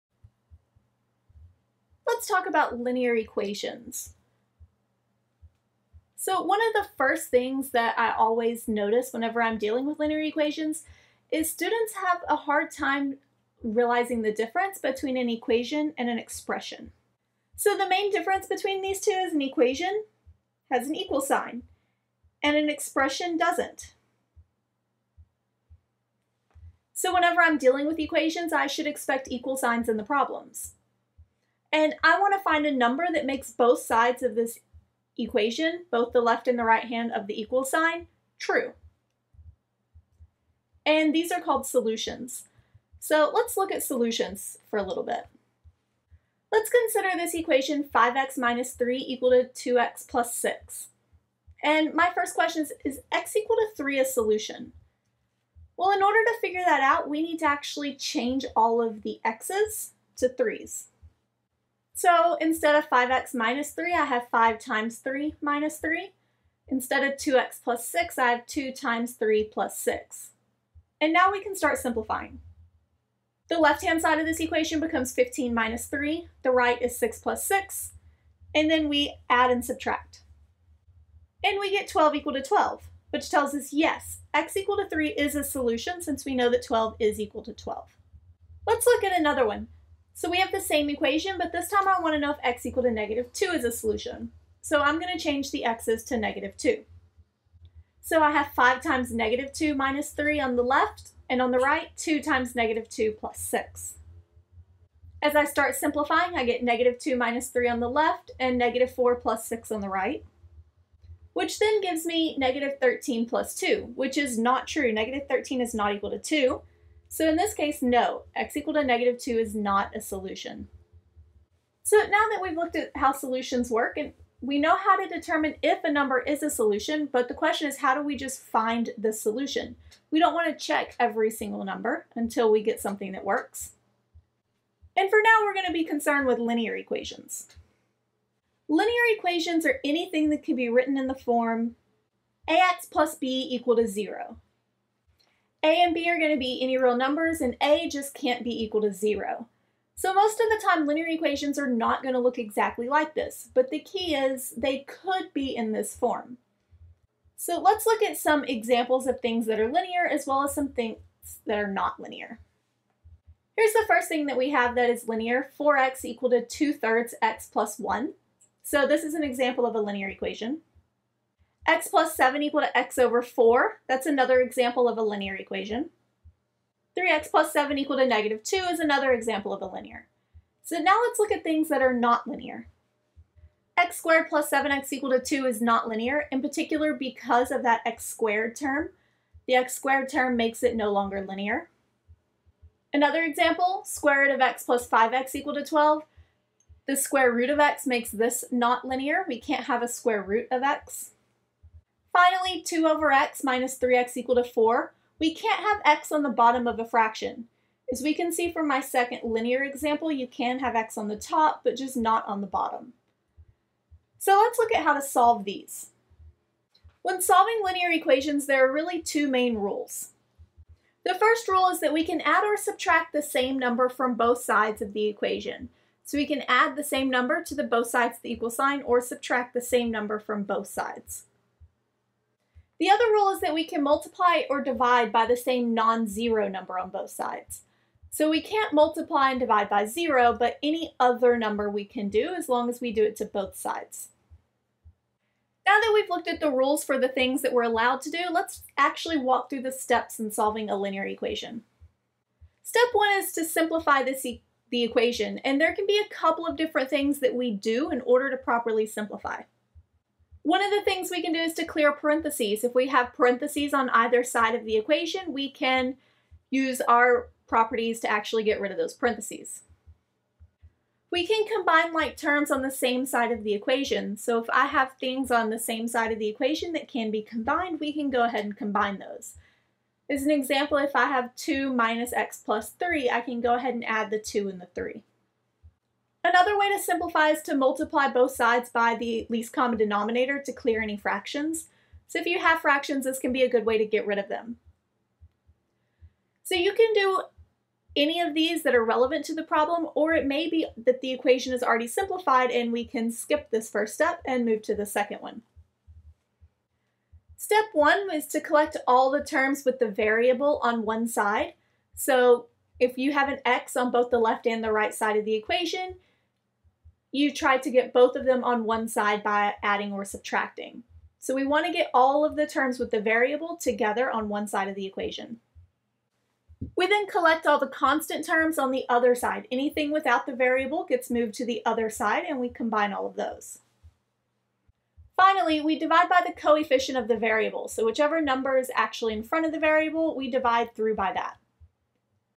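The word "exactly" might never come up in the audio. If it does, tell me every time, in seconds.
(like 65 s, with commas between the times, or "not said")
152 s.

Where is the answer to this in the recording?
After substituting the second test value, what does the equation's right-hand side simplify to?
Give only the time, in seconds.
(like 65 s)
112 s.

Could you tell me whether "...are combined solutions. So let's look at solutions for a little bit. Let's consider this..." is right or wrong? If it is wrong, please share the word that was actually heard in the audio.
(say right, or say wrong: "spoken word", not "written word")
wrong: "called", not "combined".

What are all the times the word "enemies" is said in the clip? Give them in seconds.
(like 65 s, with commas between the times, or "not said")
not said.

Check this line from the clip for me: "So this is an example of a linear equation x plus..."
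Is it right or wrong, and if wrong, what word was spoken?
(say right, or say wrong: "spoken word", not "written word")
right.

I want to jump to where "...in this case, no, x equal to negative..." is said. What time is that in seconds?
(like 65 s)
117 s.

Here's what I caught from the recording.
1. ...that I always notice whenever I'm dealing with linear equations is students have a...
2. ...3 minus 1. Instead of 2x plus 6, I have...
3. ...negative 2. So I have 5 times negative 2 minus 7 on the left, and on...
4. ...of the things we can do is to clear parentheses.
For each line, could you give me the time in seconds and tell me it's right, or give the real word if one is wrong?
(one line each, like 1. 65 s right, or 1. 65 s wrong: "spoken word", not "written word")
1. 7 s right
2. 64 s wrong: "3", not "1"
3. 96 s wrong: "3", not "7"
4. 260 s right.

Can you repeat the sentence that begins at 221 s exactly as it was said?
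The first rule is that we can add or subtract the same number from both sides of the equation.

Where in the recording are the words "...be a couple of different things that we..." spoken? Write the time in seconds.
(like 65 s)
255 s.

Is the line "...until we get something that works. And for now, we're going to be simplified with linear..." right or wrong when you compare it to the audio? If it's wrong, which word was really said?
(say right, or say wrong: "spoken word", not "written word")
wrong: "concerned", not "simplified".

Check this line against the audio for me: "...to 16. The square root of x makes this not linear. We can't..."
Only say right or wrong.
wrong.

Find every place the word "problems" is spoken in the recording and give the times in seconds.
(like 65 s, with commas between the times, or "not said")
30 s, 299 s.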